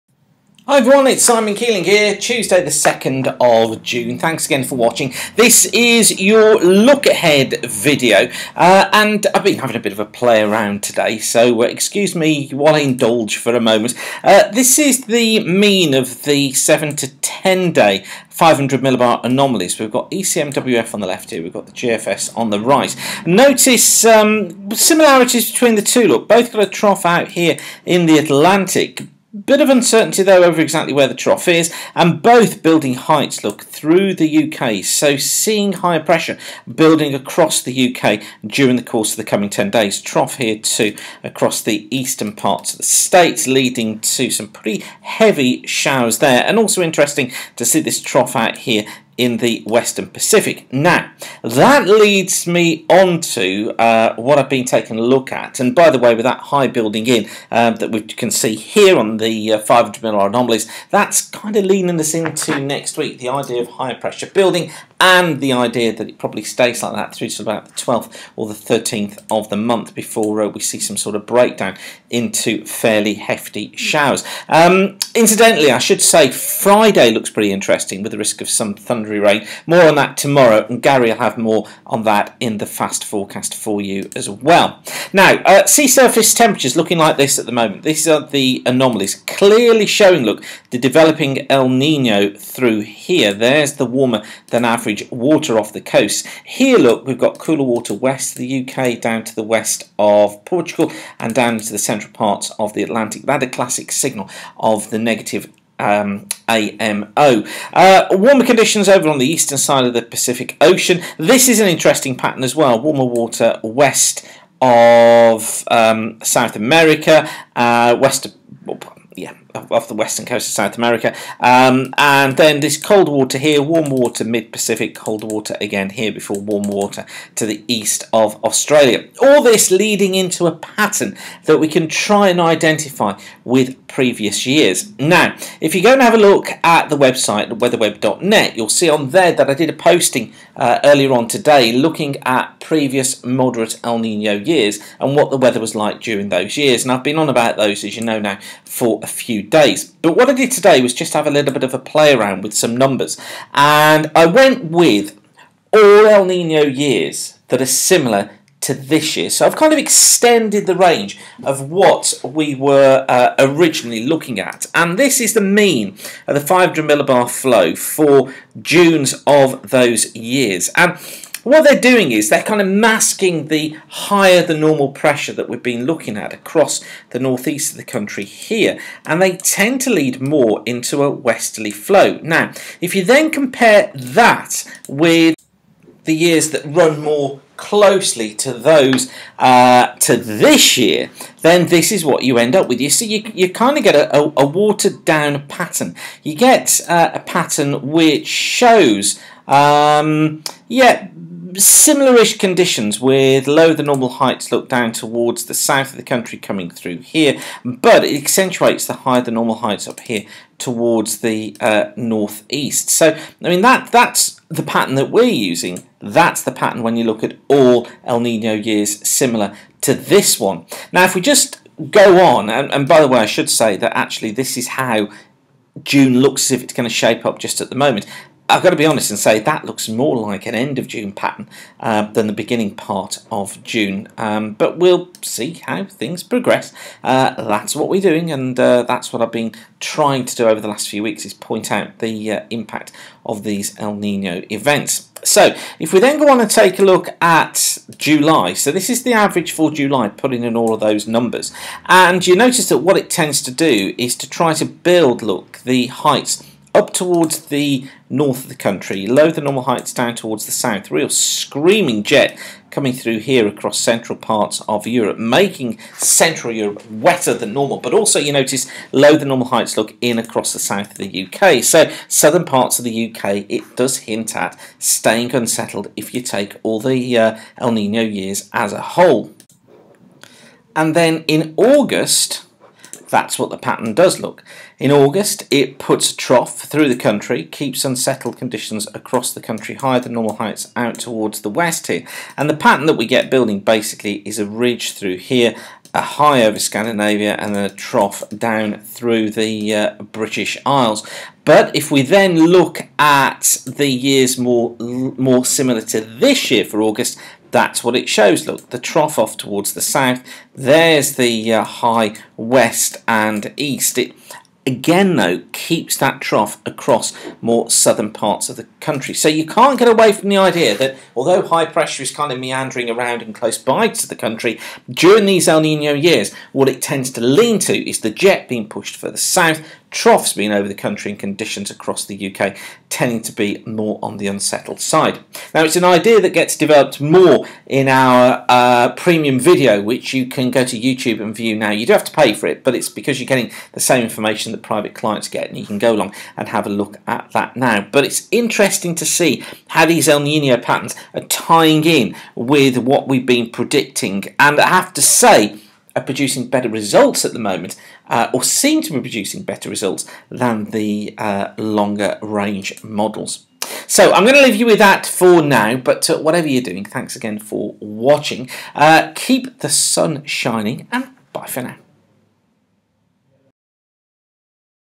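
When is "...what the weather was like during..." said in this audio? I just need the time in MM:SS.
02:25.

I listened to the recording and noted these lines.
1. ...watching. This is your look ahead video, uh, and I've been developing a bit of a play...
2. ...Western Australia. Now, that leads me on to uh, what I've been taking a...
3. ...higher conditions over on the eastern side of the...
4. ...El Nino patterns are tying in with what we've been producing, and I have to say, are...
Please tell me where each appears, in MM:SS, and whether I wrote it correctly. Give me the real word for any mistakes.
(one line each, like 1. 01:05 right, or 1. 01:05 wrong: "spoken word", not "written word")
1. 00:04 wrong: "having", not "developing"
2. 00:49 wrong: "Pacific", not "Australia"
3. 01:48 wrong: "warmer", not "higher"
4. 05:50 wrong: "predicting", not "producing".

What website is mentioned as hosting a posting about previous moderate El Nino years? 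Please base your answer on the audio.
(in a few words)
weatherweb.net.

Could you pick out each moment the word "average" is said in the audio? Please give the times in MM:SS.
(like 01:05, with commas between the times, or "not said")
01:34, 04:09.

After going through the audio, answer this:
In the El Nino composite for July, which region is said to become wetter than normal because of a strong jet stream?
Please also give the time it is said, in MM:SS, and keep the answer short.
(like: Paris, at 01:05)
Central Europe, at 04:25.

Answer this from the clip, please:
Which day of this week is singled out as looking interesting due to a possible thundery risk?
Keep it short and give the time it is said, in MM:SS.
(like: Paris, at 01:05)
Friday, at 01:16.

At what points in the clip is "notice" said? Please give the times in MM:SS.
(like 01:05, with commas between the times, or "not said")
00:23, 04:12, 04:28.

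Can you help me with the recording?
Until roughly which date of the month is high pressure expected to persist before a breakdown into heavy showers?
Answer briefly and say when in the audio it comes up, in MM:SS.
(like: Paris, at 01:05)
12th or 13th, at 01:07.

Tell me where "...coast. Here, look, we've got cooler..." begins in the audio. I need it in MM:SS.
01:35.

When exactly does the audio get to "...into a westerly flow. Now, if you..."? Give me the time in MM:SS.
03:00.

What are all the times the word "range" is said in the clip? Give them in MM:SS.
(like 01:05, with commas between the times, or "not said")
02:40, 06:02.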